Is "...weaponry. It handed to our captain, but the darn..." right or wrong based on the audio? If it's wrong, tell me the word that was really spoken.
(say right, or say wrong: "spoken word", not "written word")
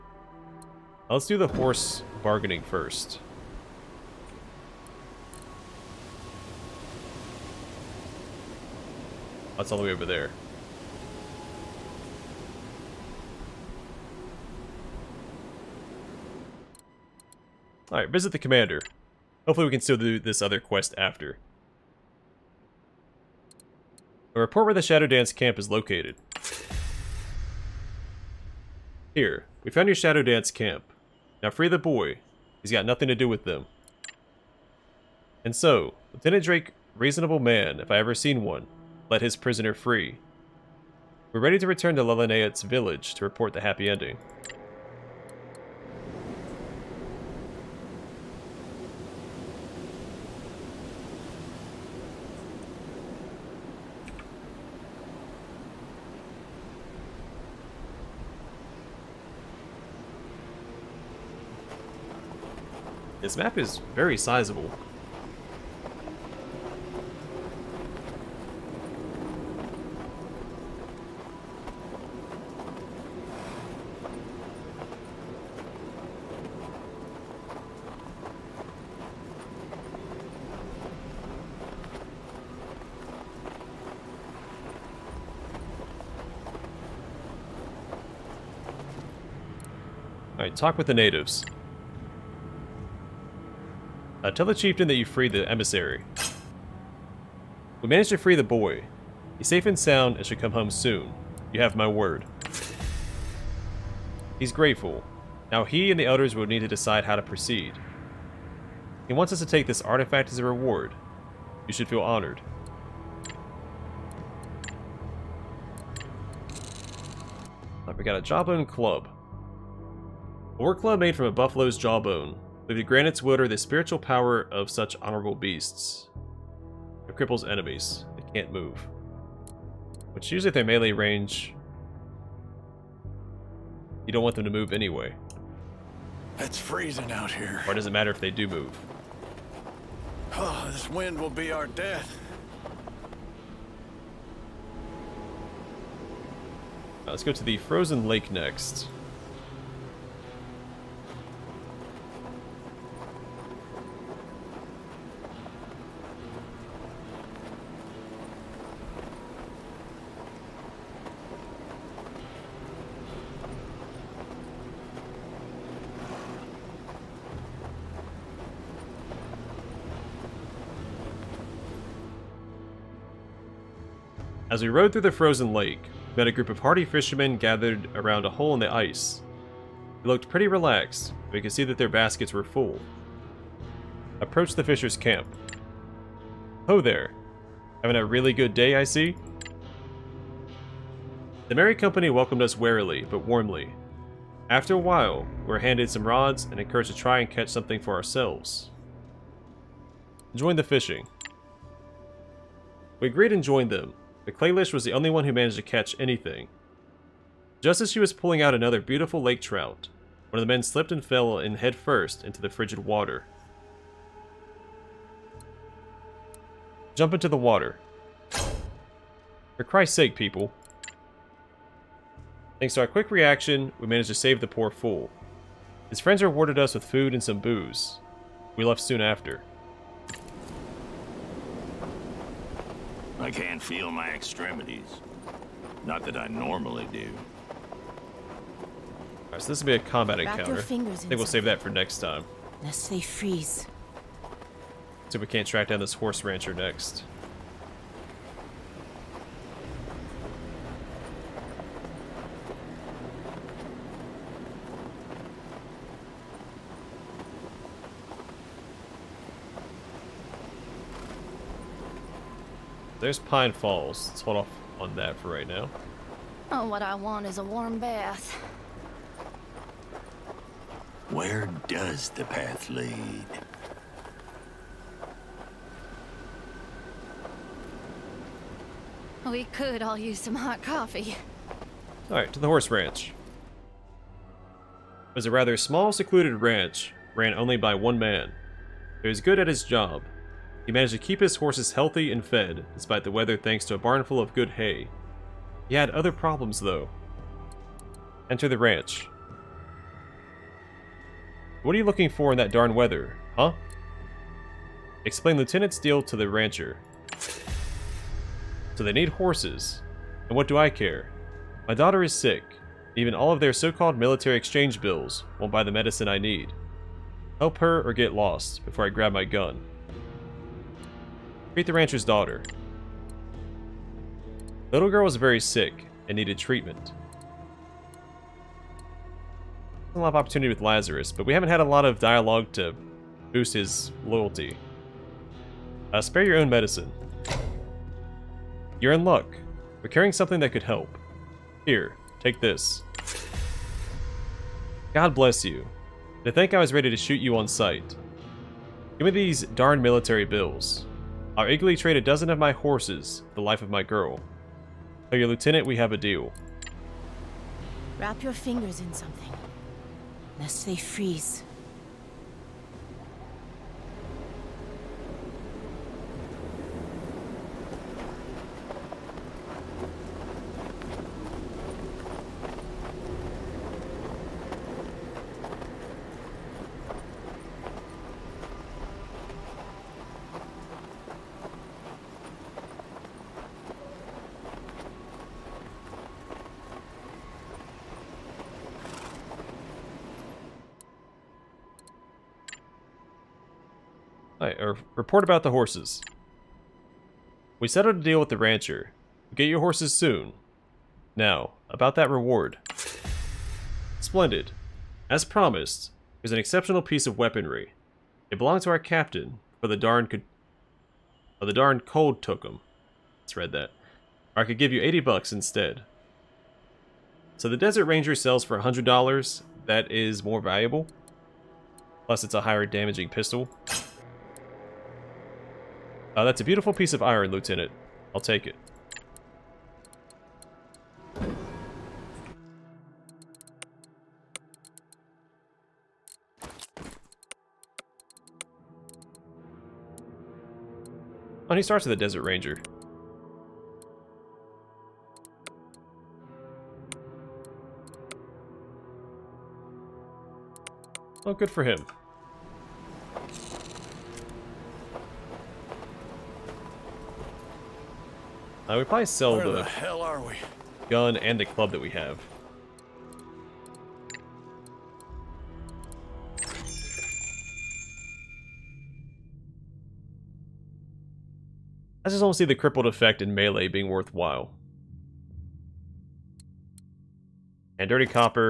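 wrong: "belonged", not "handed".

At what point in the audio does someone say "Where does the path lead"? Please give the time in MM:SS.
04:31.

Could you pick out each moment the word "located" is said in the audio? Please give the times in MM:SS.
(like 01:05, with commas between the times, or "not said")
00:25.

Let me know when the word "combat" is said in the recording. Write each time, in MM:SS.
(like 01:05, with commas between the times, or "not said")
03:59.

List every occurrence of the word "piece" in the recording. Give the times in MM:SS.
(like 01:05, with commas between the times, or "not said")
06:46, 07:06.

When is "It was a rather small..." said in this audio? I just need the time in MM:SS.
04:45.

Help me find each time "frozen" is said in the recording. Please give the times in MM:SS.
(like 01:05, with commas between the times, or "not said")
02:27, 02:55.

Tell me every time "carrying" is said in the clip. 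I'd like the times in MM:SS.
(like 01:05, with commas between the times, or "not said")
05:39.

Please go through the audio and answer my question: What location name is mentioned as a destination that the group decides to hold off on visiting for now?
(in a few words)
Pine Falls.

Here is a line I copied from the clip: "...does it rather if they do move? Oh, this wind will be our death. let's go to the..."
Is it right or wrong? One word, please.
wrong.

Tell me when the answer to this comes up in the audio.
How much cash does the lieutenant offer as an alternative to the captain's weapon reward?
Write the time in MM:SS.
06:54.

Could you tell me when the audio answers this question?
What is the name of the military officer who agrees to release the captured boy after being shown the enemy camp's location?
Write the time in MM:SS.
00:36.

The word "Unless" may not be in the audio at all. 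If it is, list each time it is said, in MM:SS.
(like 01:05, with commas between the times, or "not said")
04:02.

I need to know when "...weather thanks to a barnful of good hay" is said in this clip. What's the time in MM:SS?
04:53.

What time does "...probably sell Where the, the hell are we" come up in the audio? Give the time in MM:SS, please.
07:38.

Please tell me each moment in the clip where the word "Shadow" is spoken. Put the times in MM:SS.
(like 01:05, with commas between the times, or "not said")
00:24, 00:29.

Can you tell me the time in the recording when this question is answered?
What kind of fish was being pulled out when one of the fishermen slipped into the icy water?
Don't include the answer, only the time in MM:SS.
03:29.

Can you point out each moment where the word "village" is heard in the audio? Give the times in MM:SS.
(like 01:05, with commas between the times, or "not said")
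00:42.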